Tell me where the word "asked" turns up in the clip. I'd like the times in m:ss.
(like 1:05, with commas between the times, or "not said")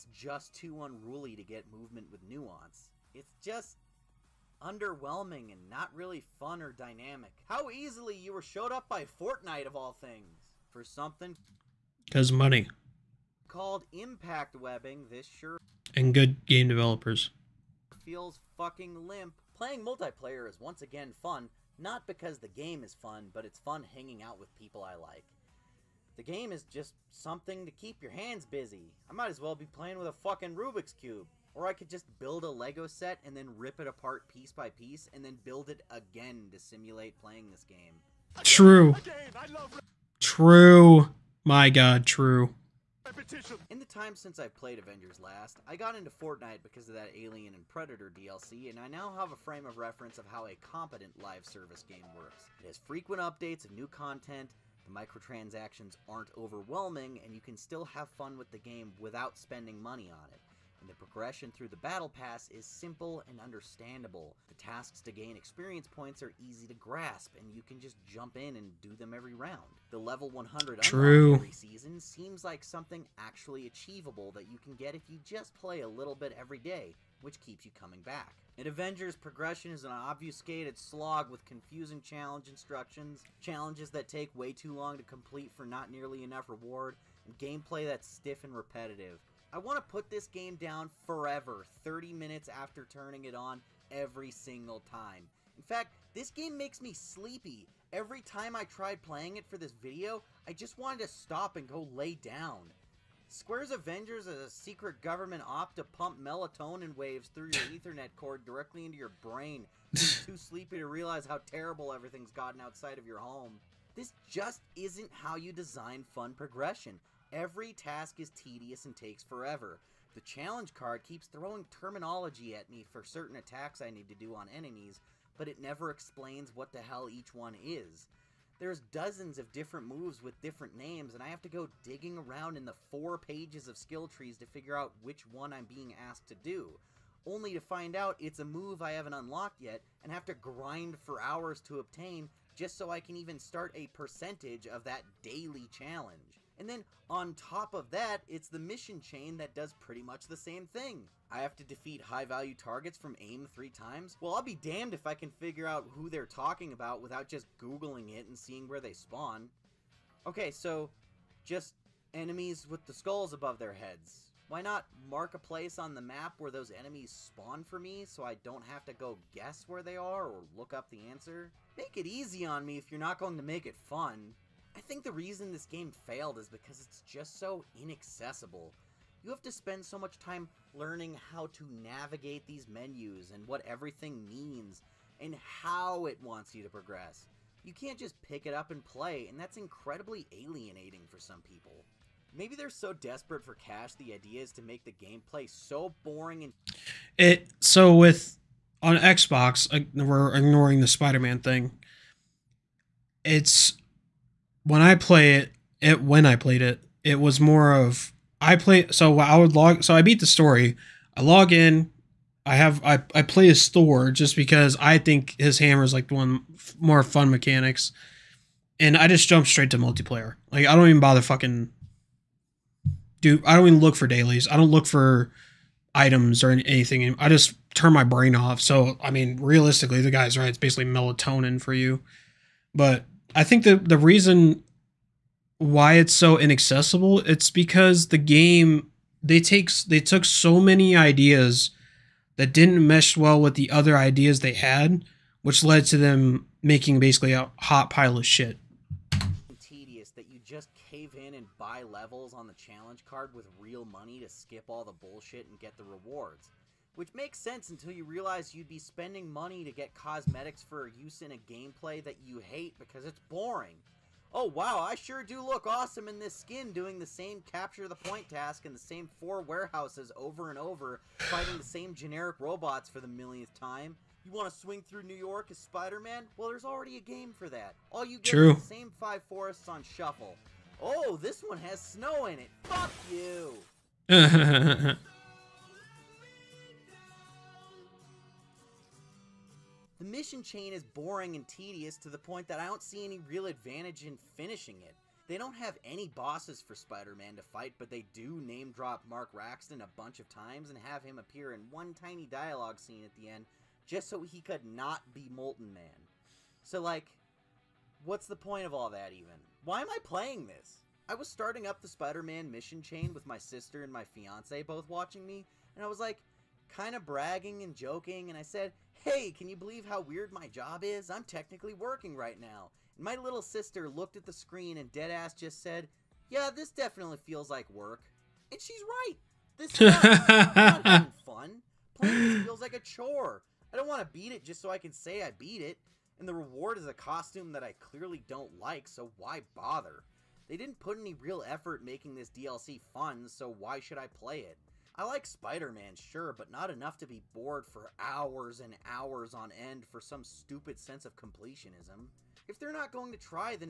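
2:16.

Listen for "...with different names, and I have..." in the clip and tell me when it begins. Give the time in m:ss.
2:10.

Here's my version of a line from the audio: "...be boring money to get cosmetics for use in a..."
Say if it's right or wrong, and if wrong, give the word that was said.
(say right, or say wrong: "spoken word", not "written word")
wrong: "spending", not "boring".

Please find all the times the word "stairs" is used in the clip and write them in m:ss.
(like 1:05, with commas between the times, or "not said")
not said.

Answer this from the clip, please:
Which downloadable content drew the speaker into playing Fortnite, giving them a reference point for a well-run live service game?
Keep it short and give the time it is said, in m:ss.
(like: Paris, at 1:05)
Alien and Predator DLC, at 0:47.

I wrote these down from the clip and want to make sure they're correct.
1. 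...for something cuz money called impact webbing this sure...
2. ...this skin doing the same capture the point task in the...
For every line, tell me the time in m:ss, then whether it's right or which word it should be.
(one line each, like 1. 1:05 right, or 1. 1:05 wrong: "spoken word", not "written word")
1. 0:10 right
2. 4:26 right.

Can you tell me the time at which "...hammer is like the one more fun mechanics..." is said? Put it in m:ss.
3:35.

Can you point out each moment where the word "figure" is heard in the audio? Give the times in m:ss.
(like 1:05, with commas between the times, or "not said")
2:14, 2:35.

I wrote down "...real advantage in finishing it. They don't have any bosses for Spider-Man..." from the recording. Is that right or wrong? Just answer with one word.
right.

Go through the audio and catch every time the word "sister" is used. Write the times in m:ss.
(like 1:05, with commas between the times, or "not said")
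5:13, 5:23.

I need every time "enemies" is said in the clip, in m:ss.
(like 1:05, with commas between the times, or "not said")
2:04, 2:42, 2:46.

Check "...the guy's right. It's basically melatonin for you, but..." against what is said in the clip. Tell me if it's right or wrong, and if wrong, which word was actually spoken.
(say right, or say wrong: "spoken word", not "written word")
right.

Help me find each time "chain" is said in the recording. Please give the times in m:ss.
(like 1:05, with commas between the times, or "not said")
2:29, 4:50, 5:12.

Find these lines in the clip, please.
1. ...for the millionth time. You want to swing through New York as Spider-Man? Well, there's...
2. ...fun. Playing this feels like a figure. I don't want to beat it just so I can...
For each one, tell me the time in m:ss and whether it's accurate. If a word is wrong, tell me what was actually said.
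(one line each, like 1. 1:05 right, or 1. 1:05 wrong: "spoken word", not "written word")
1. 4:32 right
2. 5:31 wrong: "chore", not "figure".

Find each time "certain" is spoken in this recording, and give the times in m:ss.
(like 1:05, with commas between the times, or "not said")
2:03.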